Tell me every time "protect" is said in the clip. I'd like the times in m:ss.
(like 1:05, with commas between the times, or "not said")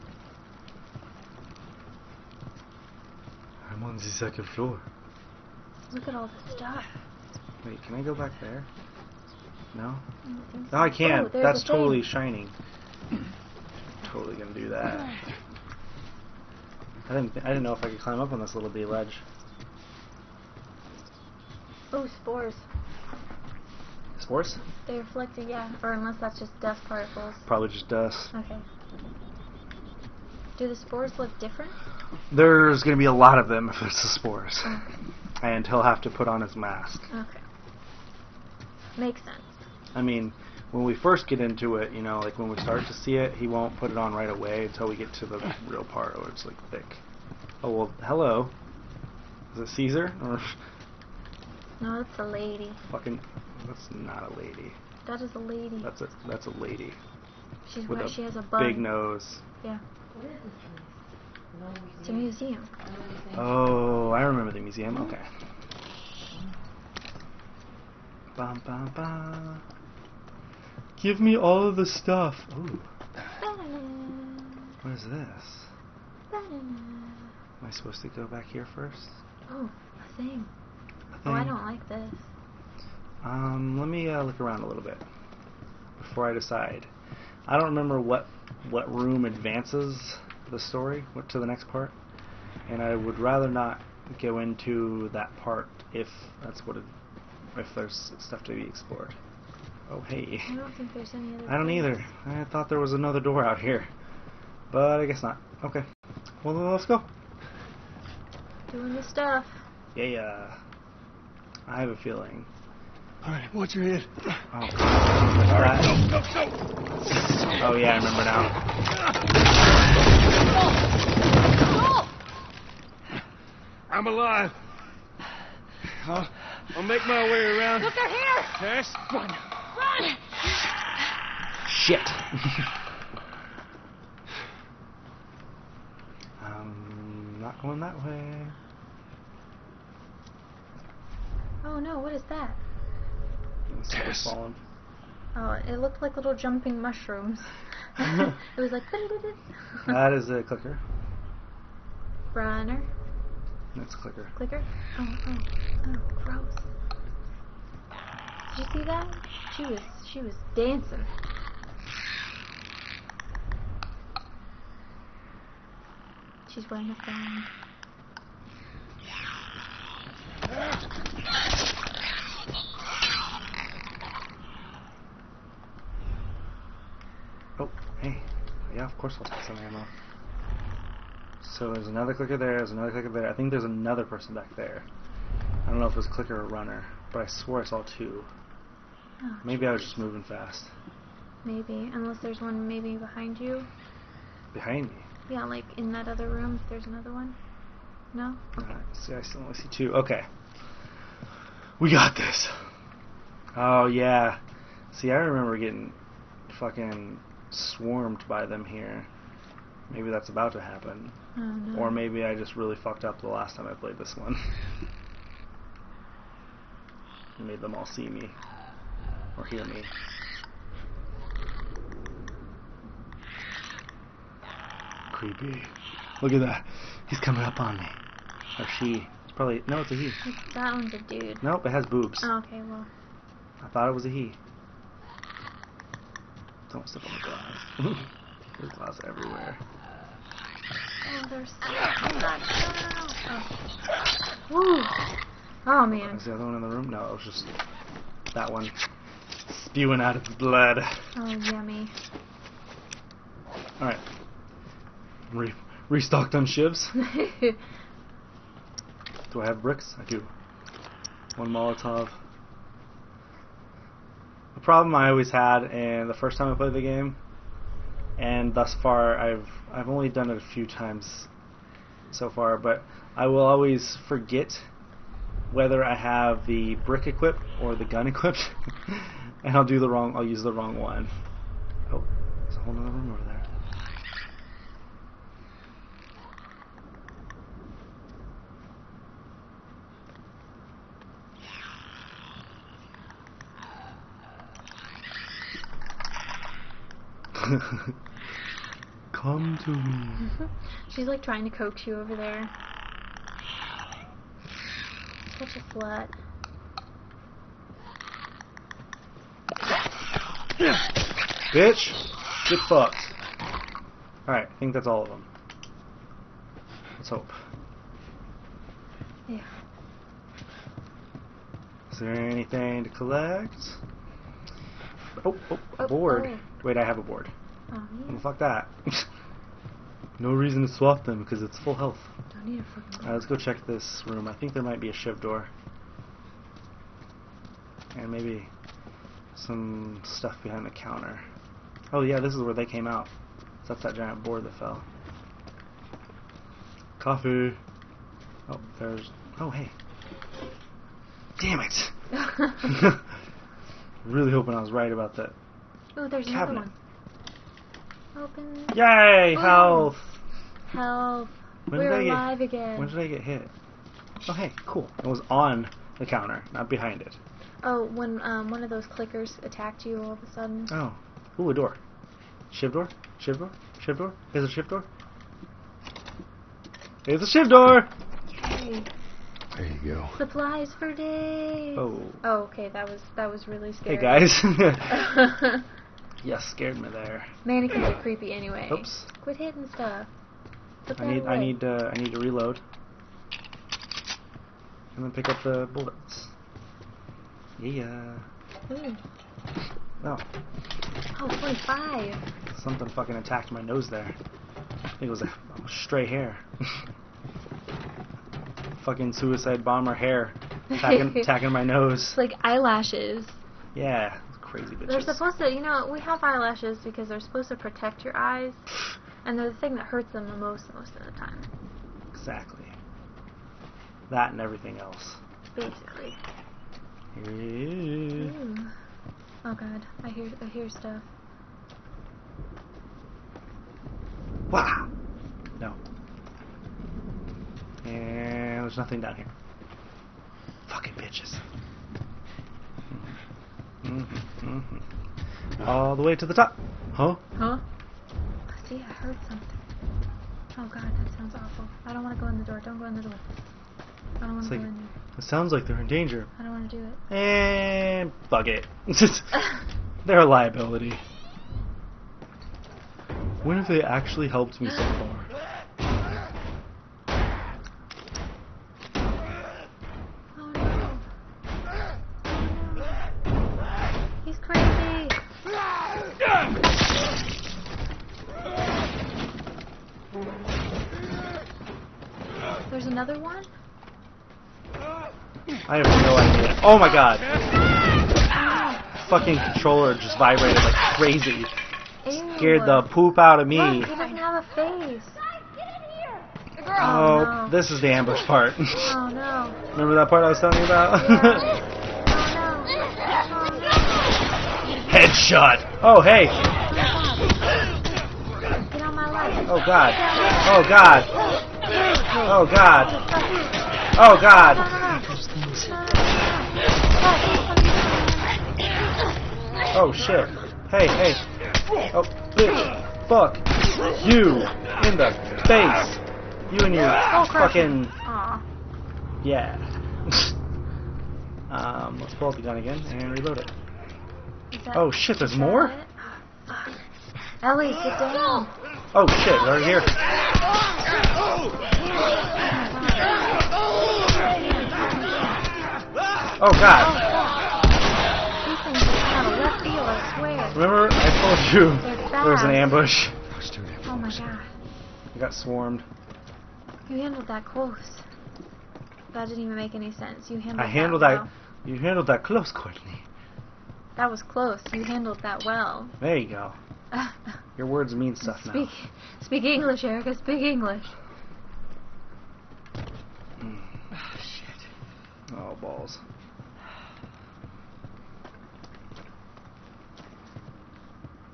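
6:57.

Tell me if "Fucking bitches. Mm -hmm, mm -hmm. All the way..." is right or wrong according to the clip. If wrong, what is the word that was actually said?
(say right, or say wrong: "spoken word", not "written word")
right.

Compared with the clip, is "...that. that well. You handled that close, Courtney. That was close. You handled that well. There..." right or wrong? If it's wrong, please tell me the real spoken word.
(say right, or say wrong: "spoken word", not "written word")
right.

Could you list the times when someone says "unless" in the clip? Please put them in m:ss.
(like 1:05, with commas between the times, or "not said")
0:25, 3:11.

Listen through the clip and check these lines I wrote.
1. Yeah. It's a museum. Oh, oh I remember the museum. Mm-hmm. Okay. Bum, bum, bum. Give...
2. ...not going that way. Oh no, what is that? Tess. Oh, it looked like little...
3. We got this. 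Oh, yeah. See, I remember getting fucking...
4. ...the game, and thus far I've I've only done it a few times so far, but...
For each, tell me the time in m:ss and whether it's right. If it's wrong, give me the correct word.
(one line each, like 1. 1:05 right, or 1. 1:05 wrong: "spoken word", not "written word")
1. 0:59 right
2. 2:17 right
3. 3:21 right
4. 4:26 right.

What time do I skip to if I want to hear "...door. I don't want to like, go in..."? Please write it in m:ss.
7:33.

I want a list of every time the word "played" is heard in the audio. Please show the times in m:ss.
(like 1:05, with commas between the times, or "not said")
3:33, 4:26.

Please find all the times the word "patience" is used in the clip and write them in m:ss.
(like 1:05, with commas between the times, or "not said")
not said.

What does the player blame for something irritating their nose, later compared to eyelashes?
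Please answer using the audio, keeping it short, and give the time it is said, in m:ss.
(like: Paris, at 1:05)
a stray hair, at 6:45.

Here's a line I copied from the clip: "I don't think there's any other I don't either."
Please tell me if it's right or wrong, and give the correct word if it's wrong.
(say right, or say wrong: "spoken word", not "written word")
right.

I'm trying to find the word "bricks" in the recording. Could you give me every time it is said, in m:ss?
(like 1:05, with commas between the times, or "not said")
4:19, 4:36.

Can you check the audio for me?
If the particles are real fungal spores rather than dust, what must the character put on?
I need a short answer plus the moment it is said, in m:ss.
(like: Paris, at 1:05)
his mask, at 0:36.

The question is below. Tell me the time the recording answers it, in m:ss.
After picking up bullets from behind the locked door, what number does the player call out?
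6:41.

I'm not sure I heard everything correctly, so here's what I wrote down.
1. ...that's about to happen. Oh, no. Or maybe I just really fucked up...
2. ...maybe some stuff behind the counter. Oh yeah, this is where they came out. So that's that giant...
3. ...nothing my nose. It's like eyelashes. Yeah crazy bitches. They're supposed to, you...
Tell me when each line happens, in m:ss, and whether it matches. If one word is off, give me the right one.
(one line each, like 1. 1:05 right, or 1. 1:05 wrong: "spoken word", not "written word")
1. 3:30 right
2. 5:38 right
3. 6:51 wrong: "attacking", not "nothing".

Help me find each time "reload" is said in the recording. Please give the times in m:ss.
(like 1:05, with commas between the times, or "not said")
6:32, 8:53.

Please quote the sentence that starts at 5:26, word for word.
Oh wait, I have a board.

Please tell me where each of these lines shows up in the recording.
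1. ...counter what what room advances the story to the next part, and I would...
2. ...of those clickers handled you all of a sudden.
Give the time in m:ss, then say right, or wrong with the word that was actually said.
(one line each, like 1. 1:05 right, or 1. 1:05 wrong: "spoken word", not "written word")
1. 1:27 wrong: "remember", not "counter"
2. 6:08 wrong: "attacked", not "handled".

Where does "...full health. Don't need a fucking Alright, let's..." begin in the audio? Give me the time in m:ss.
5:31.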